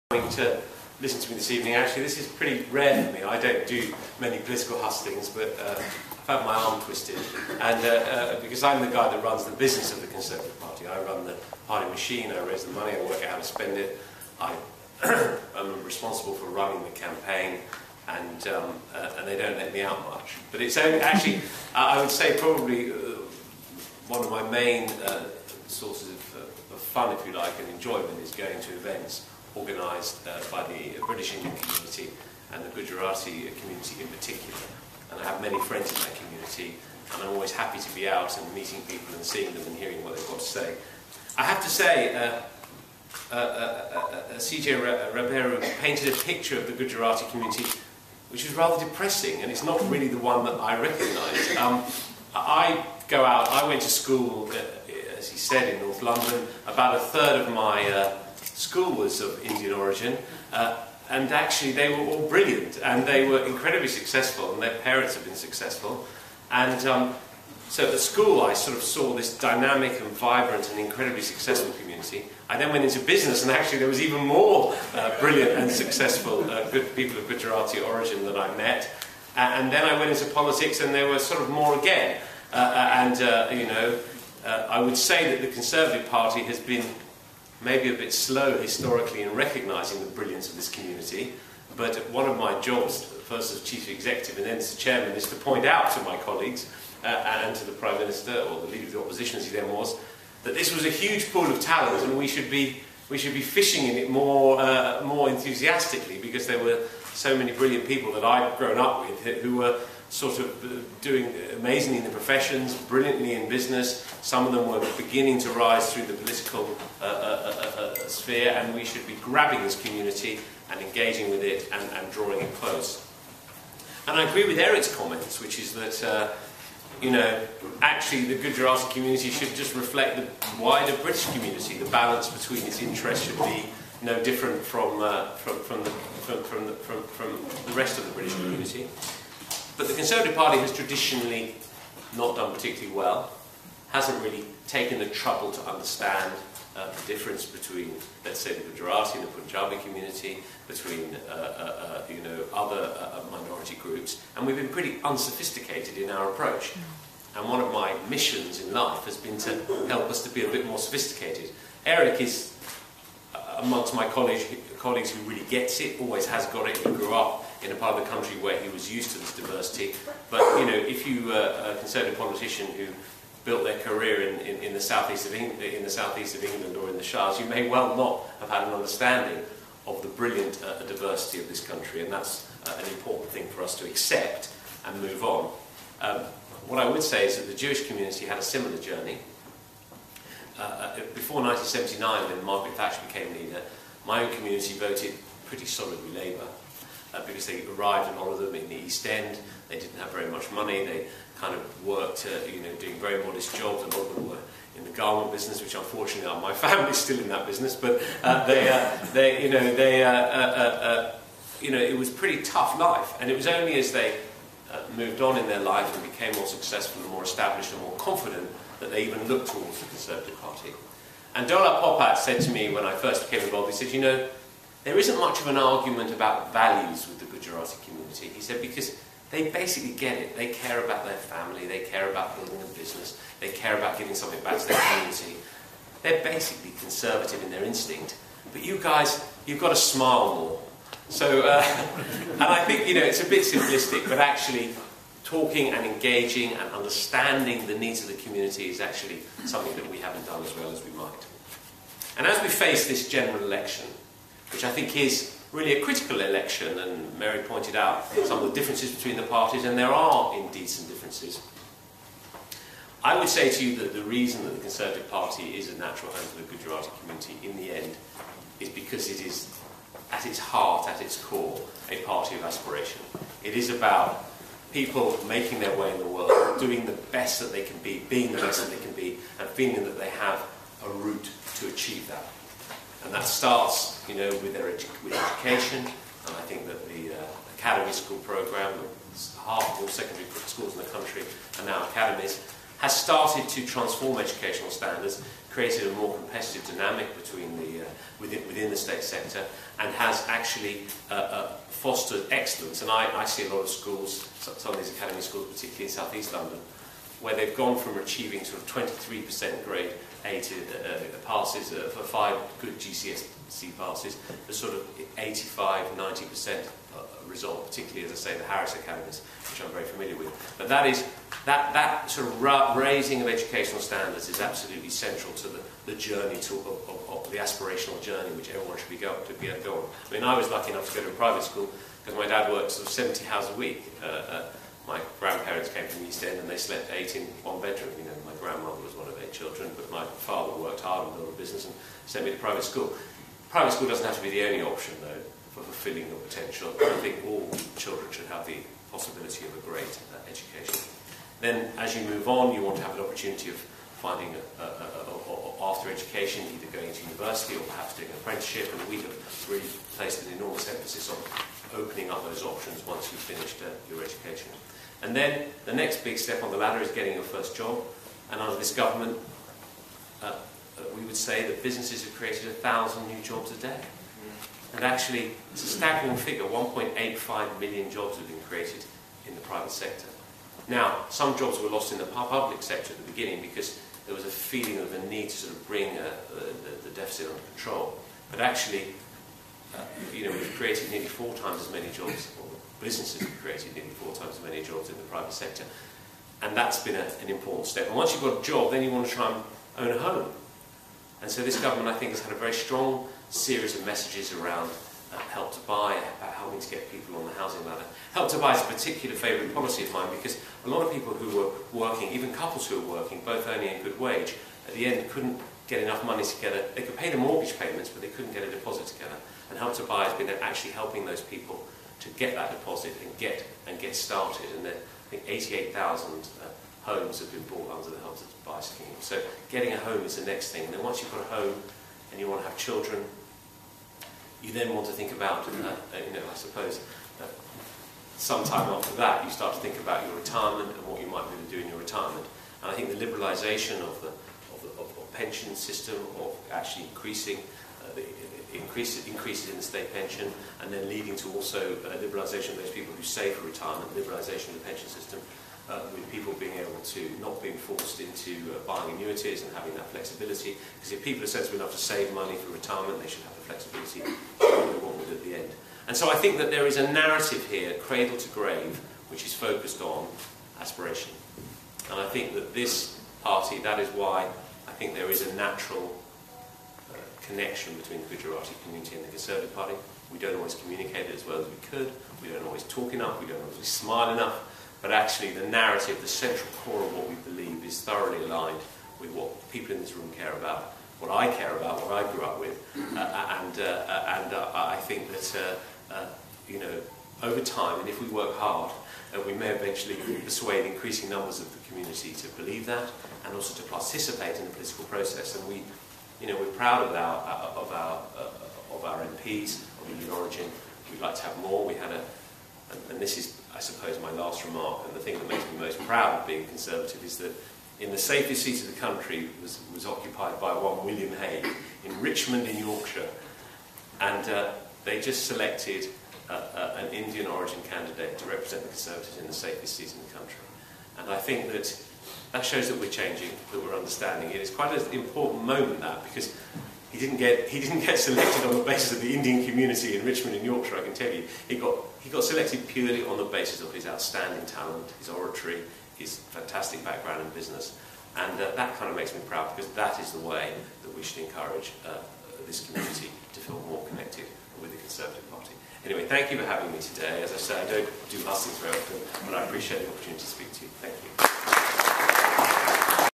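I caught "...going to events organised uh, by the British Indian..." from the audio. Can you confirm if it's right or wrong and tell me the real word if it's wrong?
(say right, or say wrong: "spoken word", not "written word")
right.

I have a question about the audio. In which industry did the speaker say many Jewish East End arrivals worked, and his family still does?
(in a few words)
garment business.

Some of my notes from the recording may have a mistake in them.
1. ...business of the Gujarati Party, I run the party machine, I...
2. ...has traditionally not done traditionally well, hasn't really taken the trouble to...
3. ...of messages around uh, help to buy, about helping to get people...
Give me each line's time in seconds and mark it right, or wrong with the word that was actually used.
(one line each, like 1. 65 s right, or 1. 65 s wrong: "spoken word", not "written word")
1. 9 s wrong: "Conservative", not "Gujarati"
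2. 140 s wrong: "particularly", not "traditionally"
3. 403 s right.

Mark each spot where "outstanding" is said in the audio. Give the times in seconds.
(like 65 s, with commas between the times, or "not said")
543 s.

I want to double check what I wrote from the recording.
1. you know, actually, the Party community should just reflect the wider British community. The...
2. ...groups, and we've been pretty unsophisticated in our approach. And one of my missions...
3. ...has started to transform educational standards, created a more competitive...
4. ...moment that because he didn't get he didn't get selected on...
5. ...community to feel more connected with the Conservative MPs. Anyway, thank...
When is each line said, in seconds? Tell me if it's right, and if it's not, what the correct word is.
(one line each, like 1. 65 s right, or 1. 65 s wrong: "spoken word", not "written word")
1. 127 s wrong: "Gujarati", not "Party"
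2. 153 s right
3. 292 s right
4. 535 s right
5. 552 s wrong: "Party", not "MPs".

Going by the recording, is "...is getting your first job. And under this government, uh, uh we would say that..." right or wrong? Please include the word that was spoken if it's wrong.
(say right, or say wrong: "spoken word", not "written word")
right.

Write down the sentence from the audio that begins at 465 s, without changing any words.
And so I think that there is a narrative here, cradle to grave, which is focused on aspiration.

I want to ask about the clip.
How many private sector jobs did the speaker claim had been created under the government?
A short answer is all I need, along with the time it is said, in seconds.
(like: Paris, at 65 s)
1.85 million, at 376 s.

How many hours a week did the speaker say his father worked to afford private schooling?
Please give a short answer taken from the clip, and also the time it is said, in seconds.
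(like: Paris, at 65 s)
70, at 332 s.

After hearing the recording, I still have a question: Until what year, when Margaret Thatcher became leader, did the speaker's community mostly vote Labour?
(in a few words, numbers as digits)
1979.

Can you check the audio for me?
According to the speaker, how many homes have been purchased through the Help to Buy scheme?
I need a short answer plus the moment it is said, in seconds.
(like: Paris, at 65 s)
88,000, at 425 s.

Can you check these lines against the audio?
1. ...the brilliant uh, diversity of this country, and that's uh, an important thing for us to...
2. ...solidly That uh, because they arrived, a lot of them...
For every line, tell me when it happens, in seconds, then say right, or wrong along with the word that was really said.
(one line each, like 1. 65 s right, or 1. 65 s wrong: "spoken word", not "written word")
1. 180 s right
2. 195 s wrong: "Labour", not "That".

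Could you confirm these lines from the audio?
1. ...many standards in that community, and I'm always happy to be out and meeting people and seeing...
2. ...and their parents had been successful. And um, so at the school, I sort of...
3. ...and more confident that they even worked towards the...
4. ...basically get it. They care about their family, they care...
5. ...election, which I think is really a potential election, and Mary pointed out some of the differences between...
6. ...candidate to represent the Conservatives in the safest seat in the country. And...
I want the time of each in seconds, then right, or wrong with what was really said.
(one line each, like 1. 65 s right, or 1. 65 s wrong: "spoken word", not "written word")
1. 35 s wrong: "friends", not "standards"
2. 64 s right
3. 217 s wrong: "looked", not "worked"
4. 229 s right
5. 253 s wrong: "critical", not "potential"
6. 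527 s right.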